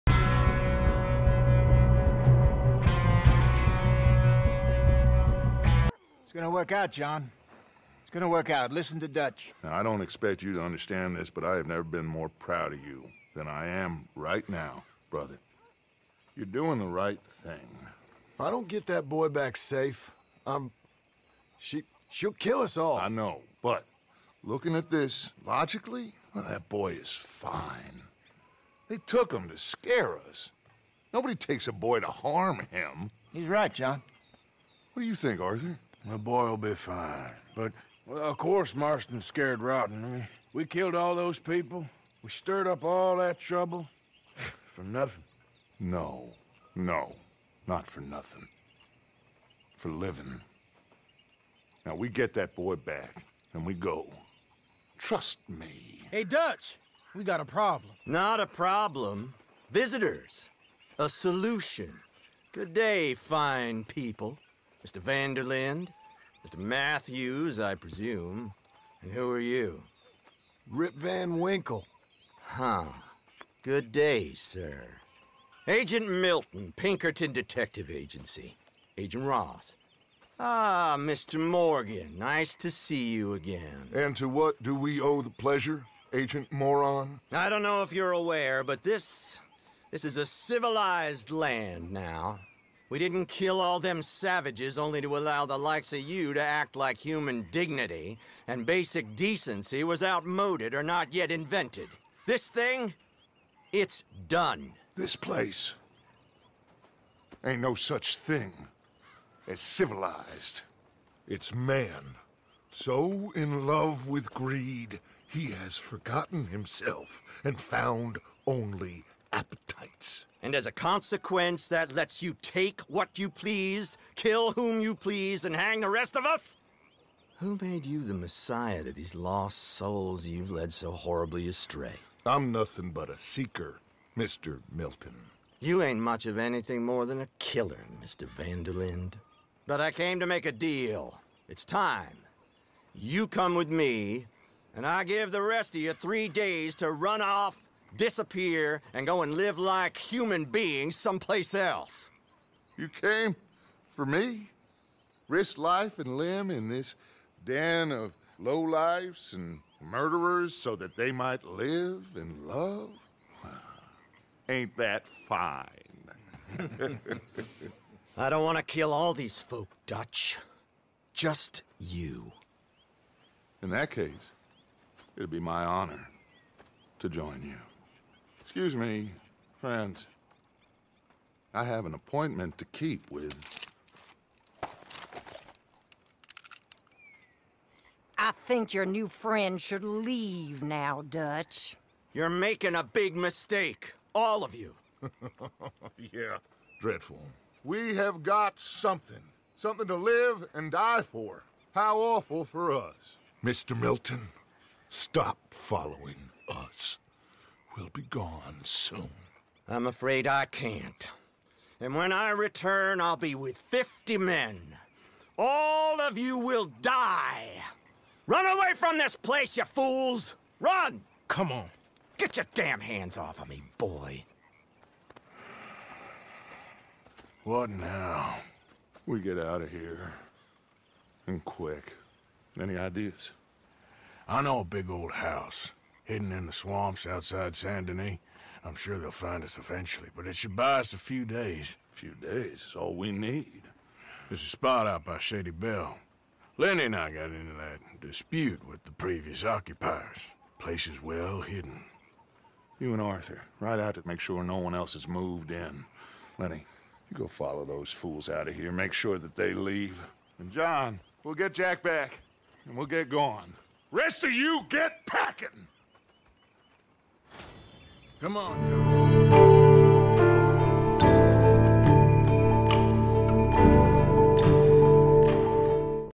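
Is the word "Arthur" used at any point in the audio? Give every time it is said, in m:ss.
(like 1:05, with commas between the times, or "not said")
0:35, 4:13.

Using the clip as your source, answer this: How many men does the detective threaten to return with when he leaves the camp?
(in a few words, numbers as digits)
50.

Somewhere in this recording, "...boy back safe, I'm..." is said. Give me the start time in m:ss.
0:19.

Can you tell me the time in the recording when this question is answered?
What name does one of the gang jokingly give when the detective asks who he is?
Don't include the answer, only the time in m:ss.
1:10.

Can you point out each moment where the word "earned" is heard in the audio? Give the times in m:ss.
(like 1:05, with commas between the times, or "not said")
not said.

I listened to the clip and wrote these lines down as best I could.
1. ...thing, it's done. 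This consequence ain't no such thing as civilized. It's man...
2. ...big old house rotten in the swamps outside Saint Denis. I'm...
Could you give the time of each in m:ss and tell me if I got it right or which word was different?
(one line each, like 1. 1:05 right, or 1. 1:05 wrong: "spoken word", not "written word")
1. 1:42 wrong: "place", not "consequence"
2. 3:54 wrong: "hidden", not "rotten".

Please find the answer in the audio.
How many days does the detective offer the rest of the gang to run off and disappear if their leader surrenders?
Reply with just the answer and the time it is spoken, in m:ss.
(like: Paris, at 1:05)
3, at 2:25.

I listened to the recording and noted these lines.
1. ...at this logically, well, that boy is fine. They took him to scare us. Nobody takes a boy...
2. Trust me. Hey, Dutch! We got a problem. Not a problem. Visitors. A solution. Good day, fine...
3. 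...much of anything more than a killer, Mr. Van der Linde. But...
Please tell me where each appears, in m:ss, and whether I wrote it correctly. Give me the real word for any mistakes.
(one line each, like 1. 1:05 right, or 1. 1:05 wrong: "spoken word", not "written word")
1. 0:24 right
2. 0:54 right
3. 2:15 right.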